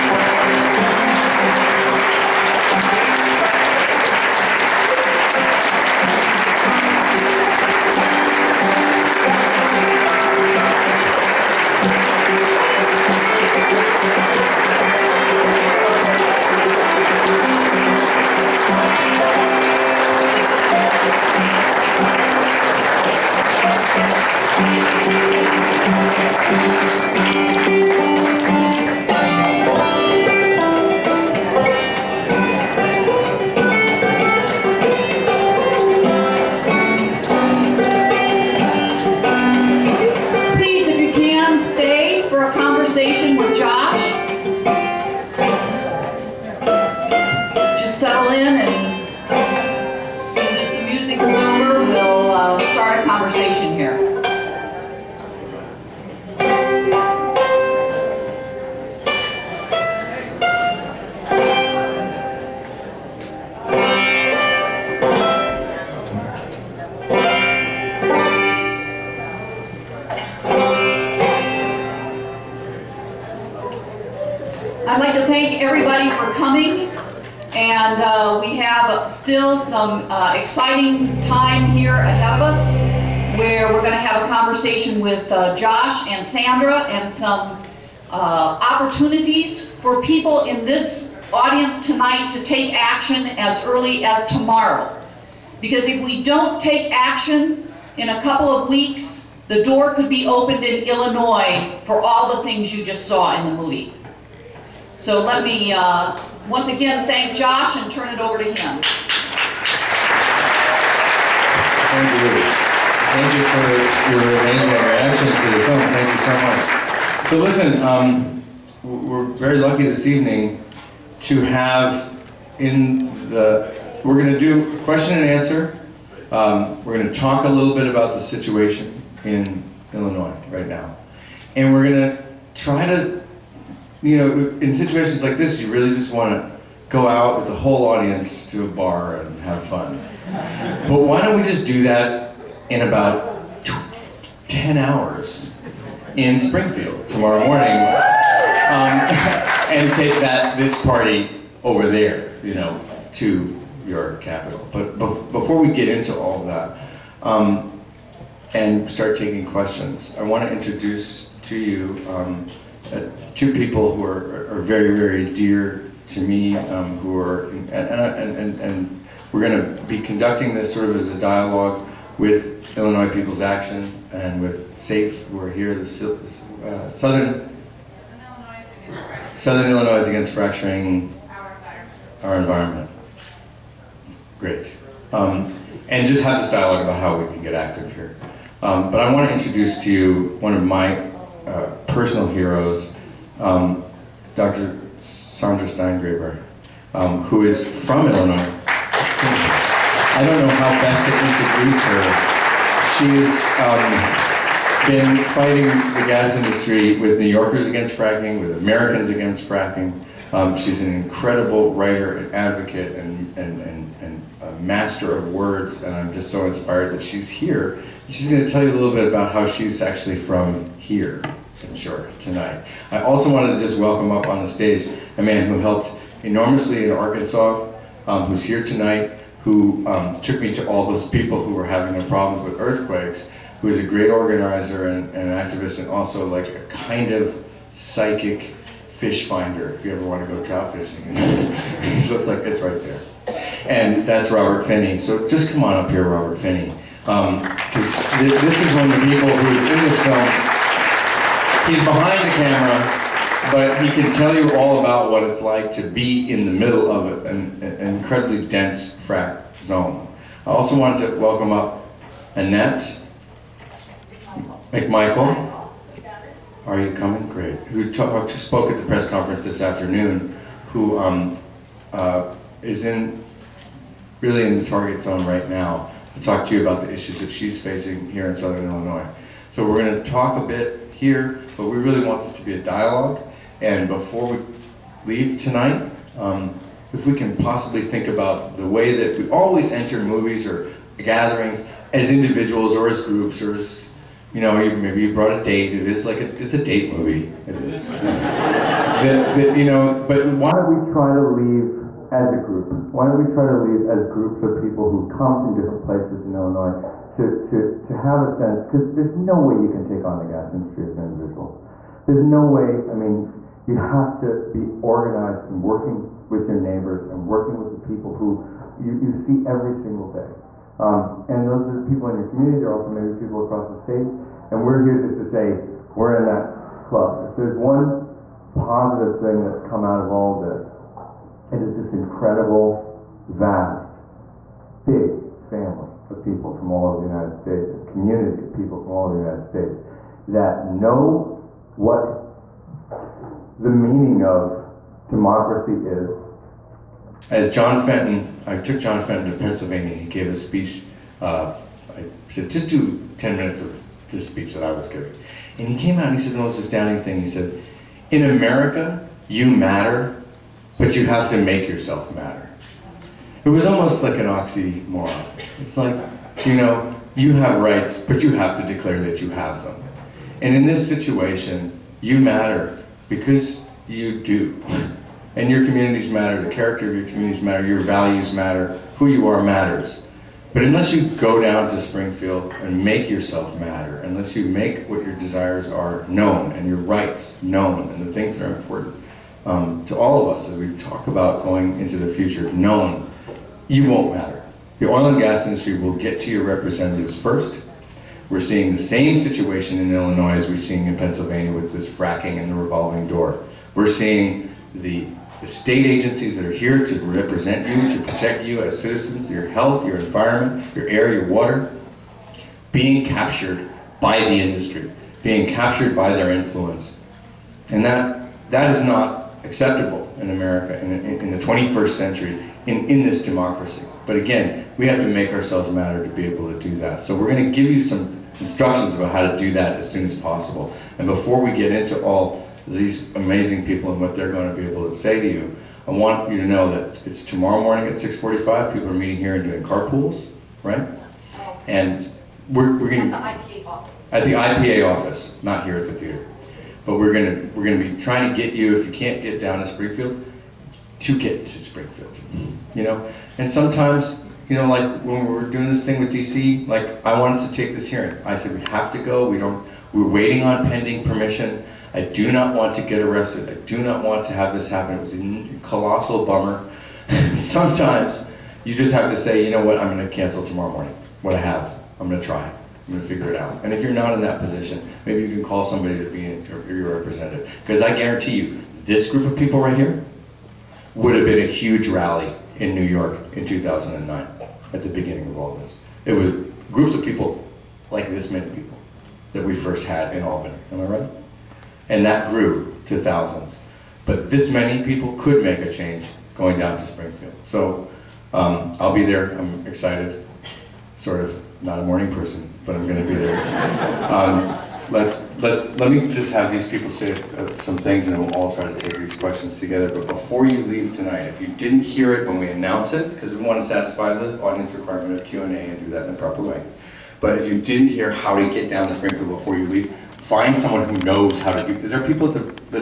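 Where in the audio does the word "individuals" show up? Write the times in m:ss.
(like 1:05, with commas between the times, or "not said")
4:52, 5:11.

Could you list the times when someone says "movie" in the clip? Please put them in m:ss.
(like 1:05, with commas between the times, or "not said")
1:43, 4:49, 4:56.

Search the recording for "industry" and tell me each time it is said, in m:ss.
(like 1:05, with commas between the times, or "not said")
3:26, 5:10, 6:35, 6:54.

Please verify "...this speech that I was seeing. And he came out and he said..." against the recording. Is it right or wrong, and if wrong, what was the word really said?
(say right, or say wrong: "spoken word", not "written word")
wrong: "giving", not "seeing".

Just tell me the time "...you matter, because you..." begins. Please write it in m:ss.
6:11.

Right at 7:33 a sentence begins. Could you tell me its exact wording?
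And sometimes you know, like when we were doing this thing with DC, like I wanted to take this hearing.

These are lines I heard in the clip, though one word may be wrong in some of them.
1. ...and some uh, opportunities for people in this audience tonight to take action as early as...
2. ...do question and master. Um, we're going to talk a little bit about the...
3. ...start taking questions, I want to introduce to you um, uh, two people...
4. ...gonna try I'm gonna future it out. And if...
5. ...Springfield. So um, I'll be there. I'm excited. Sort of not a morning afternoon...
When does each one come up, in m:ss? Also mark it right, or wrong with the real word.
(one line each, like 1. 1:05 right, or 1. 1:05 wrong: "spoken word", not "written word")
1. 1:26 right
2. 2:04 wrong: "answer", not "master"
3. 2:38 right
4. 7:52 wrong: "figure", not "future"
5. 8:16 wrong: "person", not "afternoon".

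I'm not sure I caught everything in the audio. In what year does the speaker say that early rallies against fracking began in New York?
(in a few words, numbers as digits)
2009.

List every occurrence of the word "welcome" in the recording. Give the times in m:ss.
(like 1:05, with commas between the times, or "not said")
3:43, 4:21.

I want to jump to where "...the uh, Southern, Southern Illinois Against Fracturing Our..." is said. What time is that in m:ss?
2:55.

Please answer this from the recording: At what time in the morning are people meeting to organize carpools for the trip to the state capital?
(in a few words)
6:45.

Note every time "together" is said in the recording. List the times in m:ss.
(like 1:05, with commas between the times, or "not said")
8:29.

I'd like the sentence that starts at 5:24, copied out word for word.
And we're here just to say, we're in that club.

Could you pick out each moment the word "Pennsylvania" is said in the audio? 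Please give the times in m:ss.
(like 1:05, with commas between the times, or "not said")
5:49, 6:40.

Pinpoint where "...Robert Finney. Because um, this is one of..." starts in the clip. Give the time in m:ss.
4:06.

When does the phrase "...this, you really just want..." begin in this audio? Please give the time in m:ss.
2:15.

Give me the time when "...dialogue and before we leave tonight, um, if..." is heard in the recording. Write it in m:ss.
4:42.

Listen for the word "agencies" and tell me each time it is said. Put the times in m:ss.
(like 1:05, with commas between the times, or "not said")
6:45.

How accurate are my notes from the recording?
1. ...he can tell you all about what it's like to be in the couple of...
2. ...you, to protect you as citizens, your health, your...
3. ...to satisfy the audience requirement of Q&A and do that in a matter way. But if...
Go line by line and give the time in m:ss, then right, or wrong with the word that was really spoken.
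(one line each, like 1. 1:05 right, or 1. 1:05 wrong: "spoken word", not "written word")
1. 4:13 wrong: "middle", not "couple"
2. 6:47 right
3. 8:33 wrong: "proper", not "matter".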